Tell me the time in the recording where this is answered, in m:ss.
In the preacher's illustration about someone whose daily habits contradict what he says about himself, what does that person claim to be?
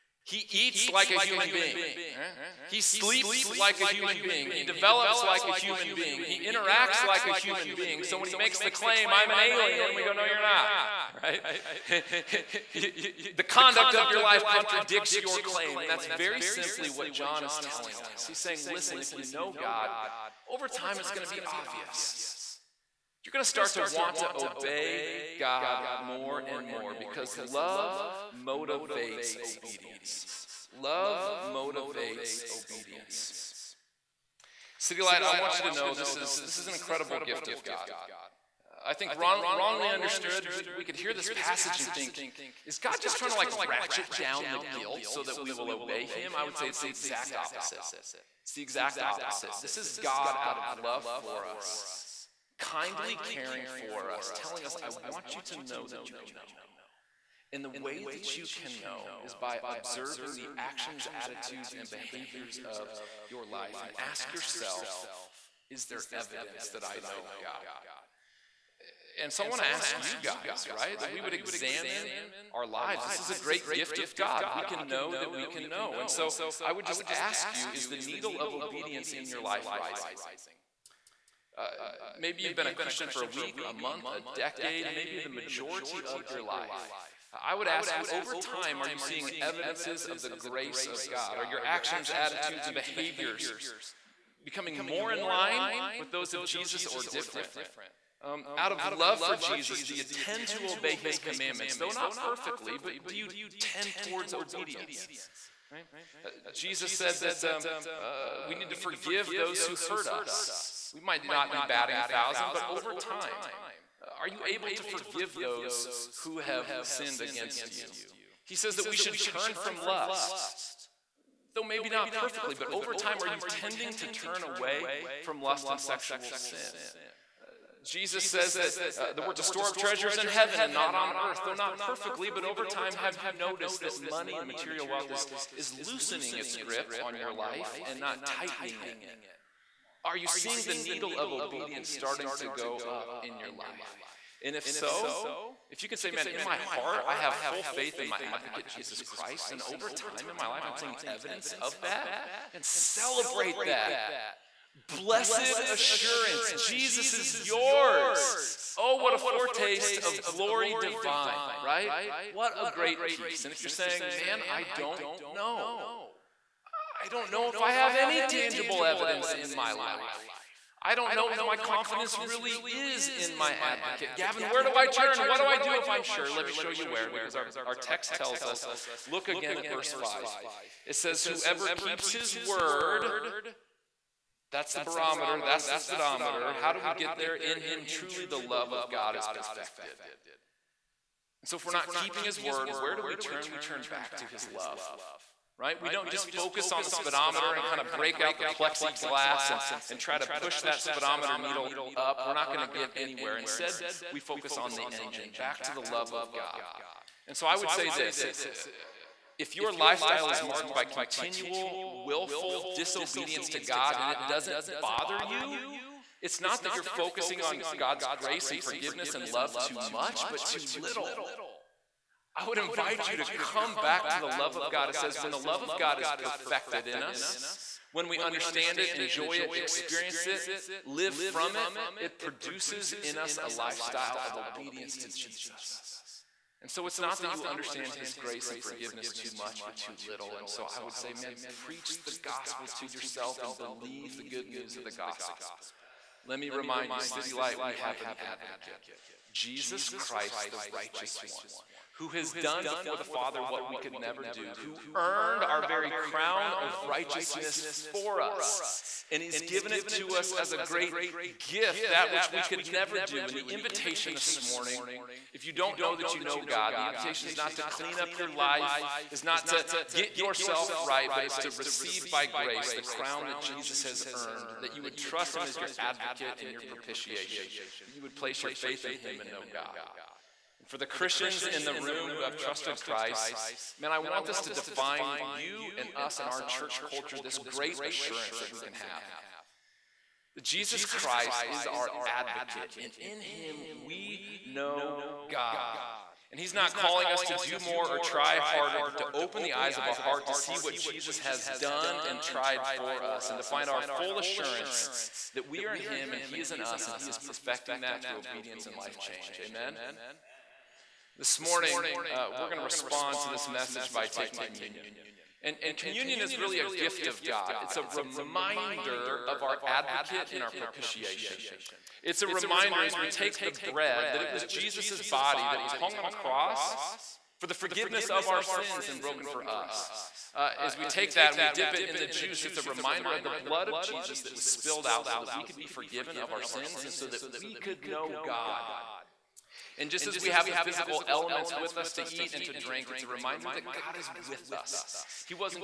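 0:09.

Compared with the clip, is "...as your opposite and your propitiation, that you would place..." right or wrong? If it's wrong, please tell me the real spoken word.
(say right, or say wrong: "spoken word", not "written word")
wrong: "advocate", not "opposite".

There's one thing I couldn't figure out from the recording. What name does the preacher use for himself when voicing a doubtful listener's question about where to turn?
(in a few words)
Gavin.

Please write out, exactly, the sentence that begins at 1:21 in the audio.
Uh, maybe you've been a Christian for a week, a month, a decade, maybe the majority of your life.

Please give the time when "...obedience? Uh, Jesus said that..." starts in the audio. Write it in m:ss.
1:44.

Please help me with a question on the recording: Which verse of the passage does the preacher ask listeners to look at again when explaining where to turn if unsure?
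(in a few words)
Verse 5.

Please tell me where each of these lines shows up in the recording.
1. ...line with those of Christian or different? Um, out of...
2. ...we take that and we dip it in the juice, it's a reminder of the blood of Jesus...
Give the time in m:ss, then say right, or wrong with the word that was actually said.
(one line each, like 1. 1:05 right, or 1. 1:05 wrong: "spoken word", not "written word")
1. 1:35 wrong: "Jesus", not "Christian"
2. 5:30 right.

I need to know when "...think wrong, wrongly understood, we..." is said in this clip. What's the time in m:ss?
0:38.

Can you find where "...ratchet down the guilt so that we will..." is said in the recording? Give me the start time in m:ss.
0:43.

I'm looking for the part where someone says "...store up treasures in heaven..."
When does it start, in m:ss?
2:09.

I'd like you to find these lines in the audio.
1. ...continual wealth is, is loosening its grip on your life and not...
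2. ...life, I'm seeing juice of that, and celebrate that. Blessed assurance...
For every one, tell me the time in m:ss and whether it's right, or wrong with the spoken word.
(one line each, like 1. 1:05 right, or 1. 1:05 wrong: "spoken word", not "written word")
1. 2:14 wrong: "material", not "continual"
2. 2:30 wrong: "evidence", not "juice".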